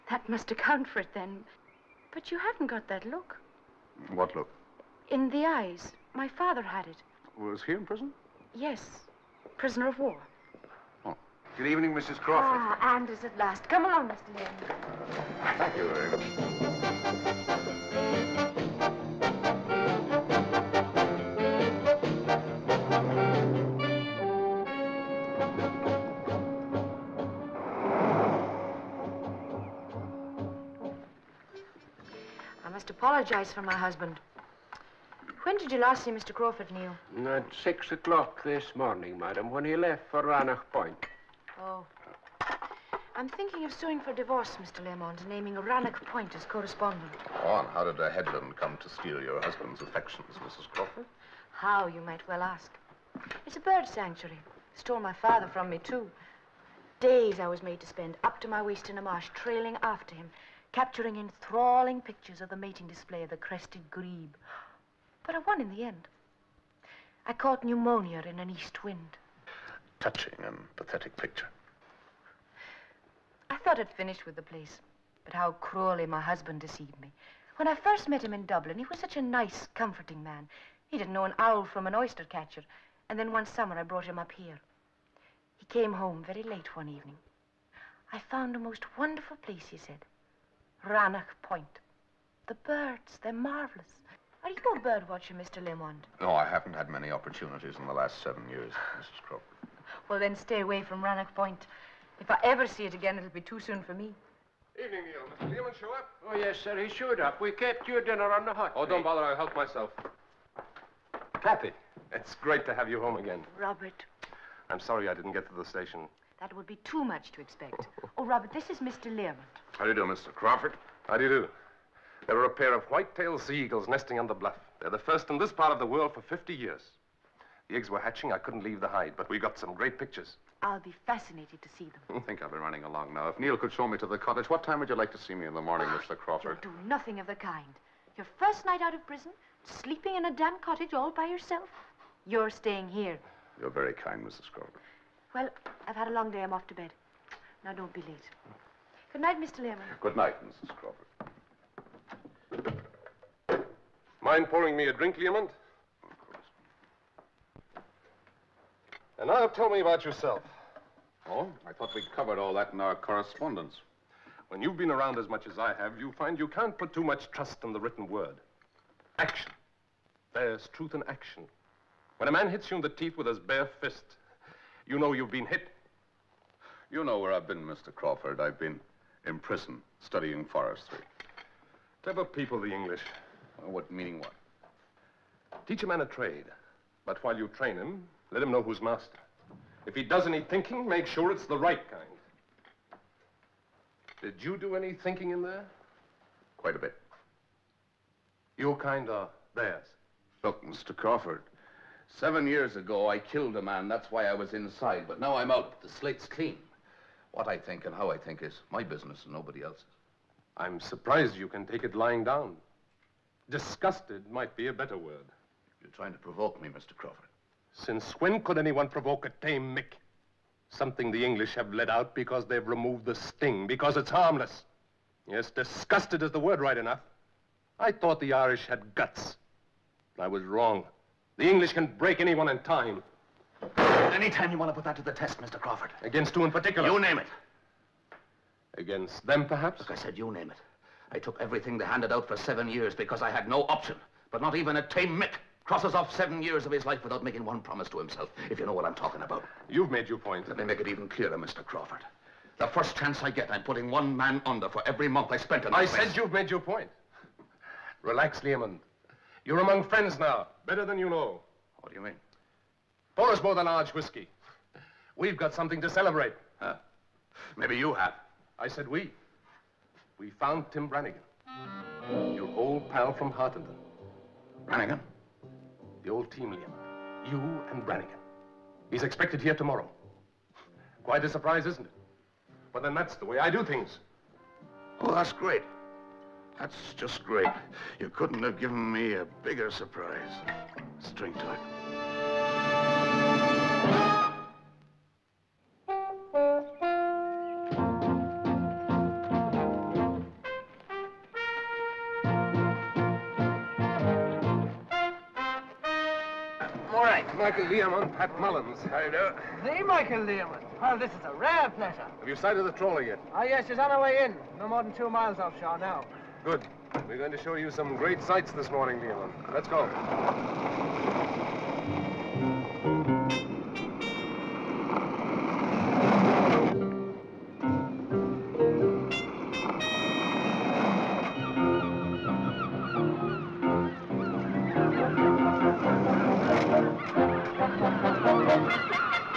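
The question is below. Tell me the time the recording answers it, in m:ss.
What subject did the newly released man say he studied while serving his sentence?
3:00.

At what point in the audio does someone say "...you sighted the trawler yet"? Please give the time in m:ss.
5:12.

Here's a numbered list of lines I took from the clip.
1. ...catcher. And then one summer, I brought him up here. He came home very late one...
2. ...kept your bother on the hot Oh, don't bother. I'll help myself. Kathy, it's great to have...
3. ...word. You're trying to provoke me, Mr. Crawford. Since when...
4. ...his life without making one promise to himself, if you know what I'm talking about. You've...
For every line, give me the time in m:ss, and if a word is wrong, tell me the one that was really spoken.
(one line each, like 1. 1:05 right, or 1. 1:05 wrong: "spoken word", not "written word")
1. 1:22 right
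2. 1:47 wrong: "dinner", not "bother"
3. 3:34 right
4. 4:06 right.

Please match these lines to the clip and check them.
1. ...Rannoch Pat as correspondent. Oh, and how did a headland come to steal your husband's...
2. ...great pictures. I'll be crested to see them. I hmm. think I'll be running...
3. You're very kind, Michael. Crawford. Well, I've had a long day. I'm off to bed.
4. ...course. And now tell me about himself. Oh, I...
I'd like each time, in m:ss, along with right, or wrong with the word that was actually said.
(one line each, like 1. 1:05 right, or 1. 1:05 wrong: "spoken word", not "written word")
1. 0:45 wrong: "Point", not "Pat"
2. 2:09 wrong: "fascinated", not "crested"
3. 2:23 wrong: "Mrs", not "Michael"
4. 2:36 wrong: "yourself", not "himself".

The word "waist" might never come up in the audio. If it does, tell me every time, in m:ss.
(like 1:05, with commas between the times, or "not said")
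0:58.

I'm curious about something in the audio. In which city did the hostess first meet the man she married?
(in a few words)
Dublin.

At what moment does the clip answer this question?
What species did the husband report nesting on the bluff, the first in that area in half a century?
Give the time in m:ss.
2:02.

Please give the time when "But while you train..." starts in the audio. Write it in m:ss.
3:07.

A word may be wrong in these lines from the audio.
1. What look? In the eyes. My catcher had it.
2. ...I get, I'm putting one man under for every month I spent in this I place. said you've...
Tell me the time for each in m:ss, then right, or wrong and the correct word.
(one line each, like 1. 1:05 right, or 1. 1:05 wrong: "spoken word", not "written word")
1. 0:04 wrong: "father", not "catcher"
2. 4:13 right.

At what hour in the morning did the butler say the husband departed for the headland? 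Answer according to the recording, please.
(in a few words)
6.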